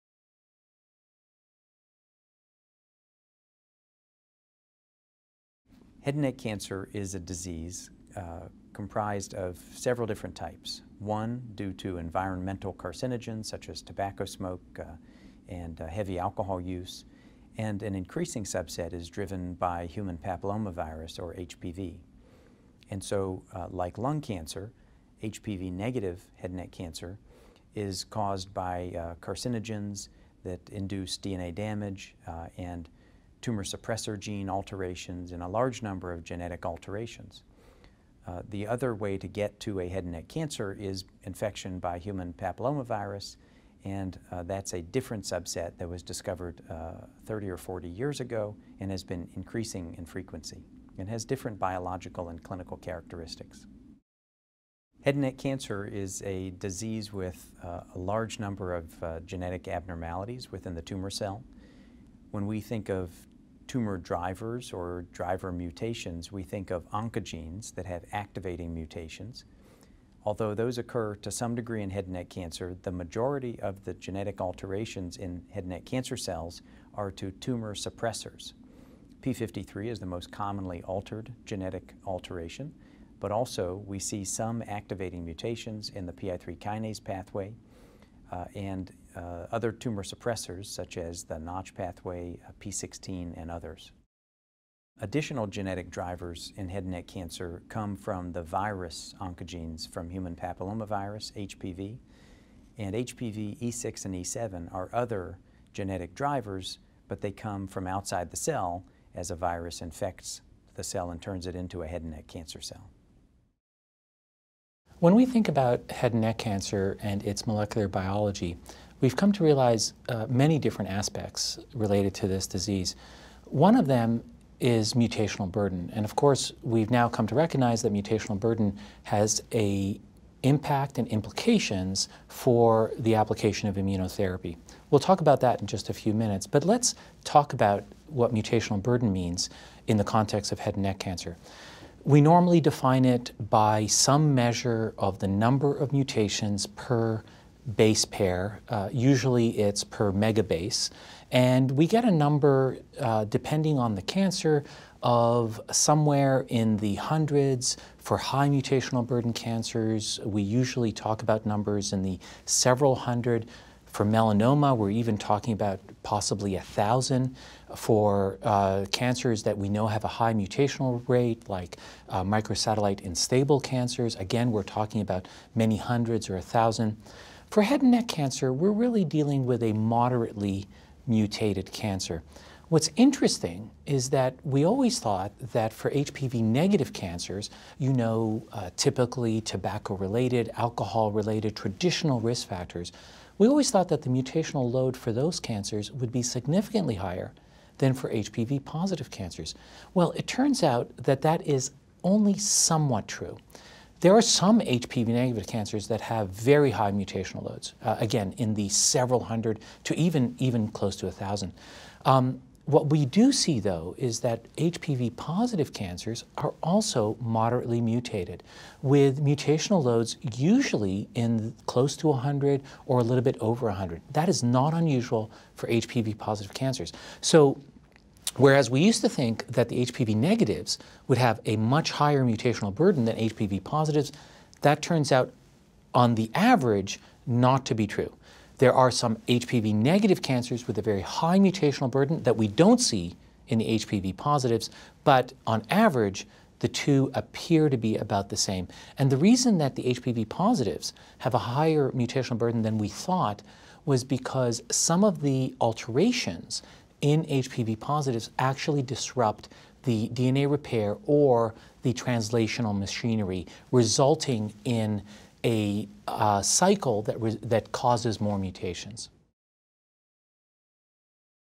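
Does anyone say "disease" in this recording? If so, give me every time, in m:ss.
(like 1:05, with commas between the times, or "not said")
0:07, 0:56, 2:02.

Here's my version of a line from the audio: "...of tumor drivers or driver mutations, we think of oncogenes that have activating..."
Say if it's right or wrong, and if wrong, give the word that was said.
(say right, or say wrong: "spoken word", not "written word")
right.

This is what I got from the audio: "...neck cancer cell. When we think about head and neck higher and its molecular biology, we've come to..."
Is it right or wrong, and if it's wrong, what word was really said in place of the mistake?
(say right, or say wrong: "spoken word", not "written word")
wrong: "cancer", not "higher".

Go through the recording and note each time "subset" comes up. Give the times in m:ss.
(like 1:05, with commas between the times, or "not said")
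0:18, 0:45.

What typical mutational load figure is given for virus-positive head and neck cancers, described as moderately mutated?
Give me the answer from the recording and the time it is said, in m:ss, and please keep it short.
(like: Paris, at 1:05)
close to 100, at 3:41.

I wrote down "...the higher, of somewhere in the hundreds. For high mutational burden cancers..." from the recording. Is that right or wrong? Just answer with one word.
wrong.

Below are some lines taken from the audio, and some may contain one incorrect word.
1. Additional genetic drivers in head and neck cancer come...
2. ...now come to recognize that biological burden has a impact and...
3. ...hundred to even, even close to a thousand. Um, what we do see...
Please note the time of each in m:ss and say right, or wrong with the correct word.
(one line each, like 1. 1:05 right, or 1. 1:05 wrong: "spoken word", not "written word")
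1. 1:35 right
2. 2:06 wrong: "mutational", not "biological"
3. 3:29 right.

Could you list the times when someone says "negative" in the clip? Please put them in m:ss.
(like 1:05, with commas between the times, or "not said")
0:25, 3:06, 3:25, 3:50, 3:59.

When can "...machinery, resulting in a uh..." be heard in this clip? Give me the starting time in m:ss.
4:22.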